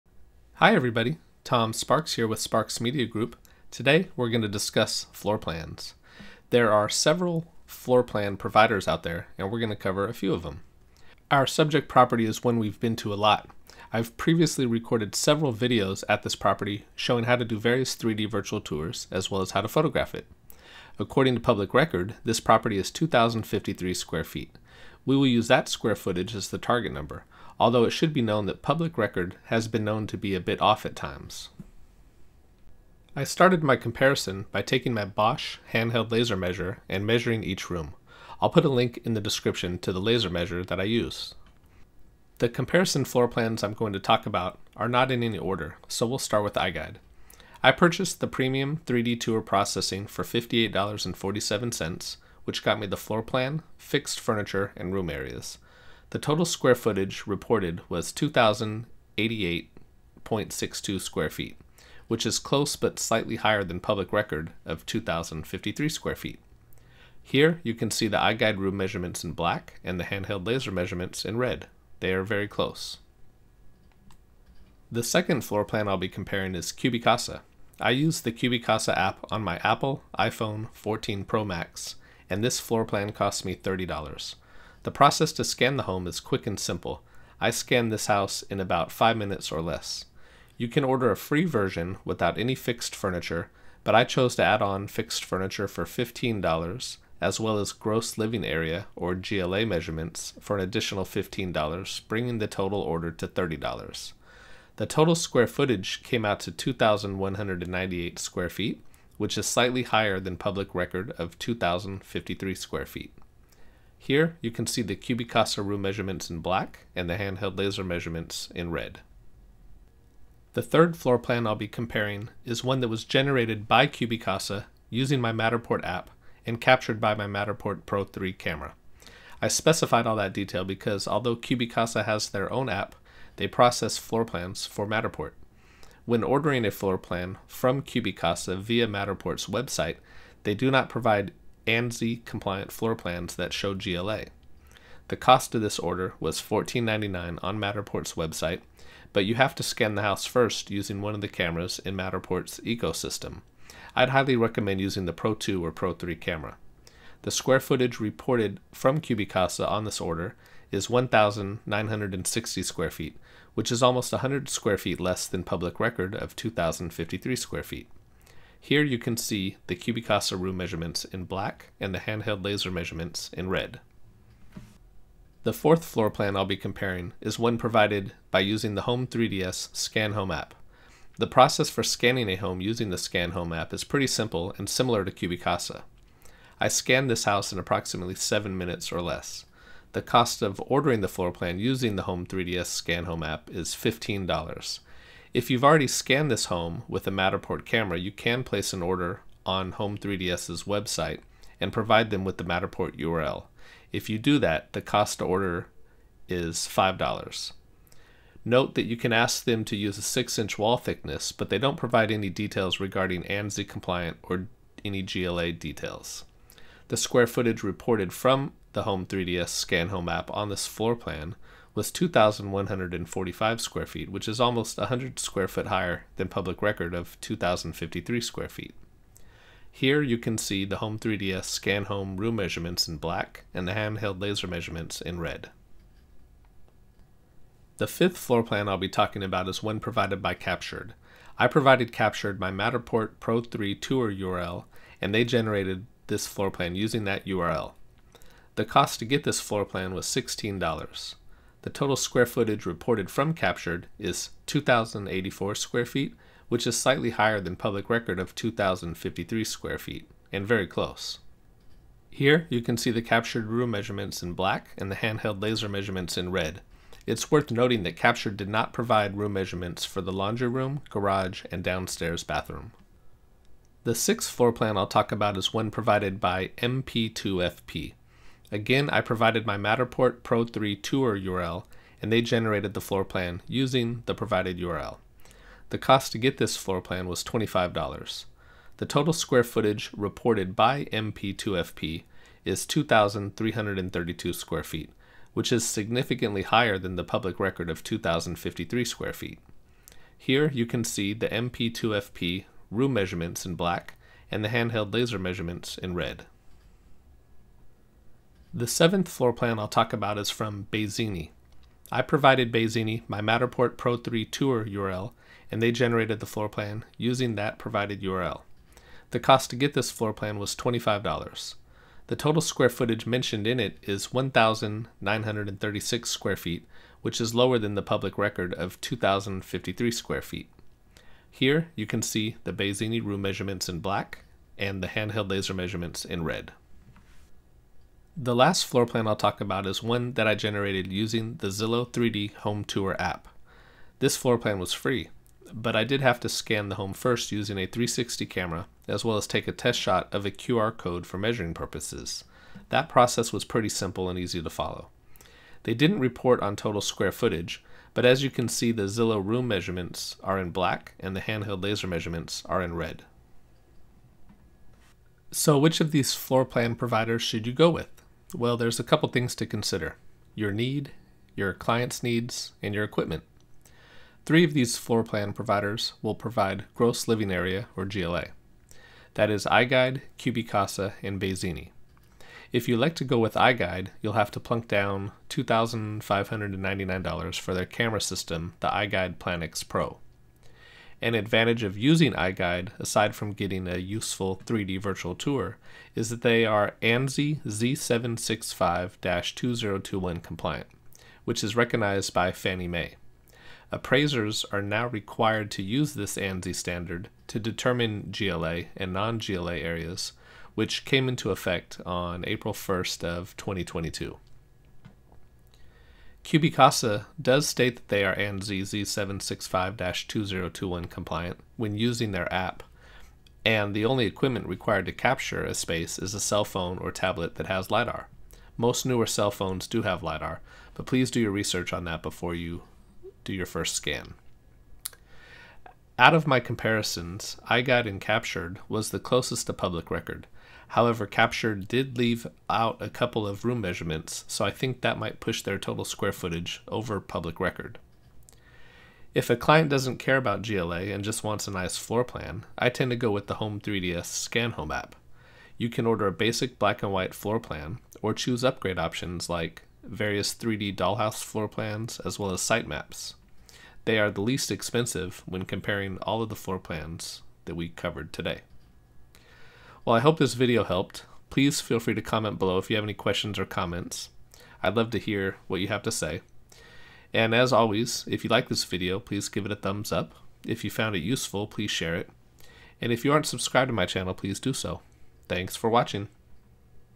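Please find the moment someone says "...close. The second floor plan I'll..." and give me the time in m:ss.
1:12.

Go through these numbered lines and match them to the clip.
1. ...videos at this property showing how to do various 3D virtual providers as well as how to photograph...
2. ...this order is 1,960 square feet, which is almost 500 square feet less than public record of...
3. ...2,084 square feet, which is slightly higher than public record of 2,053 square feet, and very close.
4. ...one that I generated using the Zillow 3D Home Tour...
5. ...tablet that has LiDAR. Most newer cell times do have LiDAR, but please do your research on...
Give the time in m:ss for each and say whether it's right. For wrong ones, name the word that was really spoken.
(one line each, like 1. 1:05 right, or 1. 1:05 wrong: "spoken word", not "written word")
1. 0:15 wrong: "tours", not "providers"
2. 2:39 wrong: "100", not "500"
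3. 4:14 right
4. 5:39 right
5. 7:06 wrong: "phones", not "times".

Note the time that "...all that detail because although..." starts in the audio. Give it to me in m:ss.
2:10.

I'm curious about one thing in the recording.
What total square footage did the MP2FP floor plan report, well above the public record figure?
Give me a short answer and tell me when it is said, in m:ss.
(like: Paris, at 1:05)
2,332 square feet, at 4:52.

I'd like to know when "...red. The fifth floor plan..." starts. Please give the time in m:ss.
3:55.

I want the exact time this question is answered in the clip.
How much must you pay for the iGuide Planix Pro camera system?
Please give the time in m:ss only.
6:25.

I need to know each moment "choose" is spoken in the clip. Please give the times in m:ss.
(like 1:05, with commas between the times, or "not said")
7:38.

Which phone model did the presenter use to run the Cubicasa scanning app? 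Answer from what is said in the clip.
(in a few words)
iPhone 14 Pro Max.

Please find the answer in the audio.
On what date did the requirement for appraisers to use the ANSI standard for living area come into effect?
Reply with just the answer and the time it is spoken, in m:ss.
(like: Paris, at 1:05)
April 1st 2022, at 6:52.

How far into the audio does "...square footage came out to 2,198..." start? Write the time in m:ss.
1:45.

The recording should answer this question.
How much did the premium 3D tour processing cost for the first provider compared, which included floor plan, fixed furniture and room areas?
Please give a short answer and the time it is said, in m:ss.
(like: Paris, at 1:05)
$58.47, at 0:50.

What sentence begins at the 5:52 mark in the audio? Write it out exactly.
That process was pretty simple and easy to follow.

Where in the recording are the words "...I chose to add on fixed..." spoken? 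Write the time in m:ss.
1:33.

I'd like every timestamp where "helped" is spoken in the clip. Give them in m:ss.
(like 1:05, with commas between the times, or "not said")
7:50.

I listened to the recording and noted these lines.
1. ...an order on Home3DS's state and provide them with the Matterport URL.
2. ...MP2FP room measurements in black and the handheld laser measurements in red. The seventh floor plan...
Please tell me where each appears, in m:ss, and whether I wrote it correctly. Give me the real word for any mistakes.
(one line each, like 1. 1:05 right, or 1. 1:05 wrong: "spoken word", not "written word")
1. 3:18 wrong: "website", not "state"
2. 5:01 right.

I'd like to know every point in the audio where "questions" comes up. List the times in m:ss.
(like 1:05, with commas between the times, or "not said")
7:52.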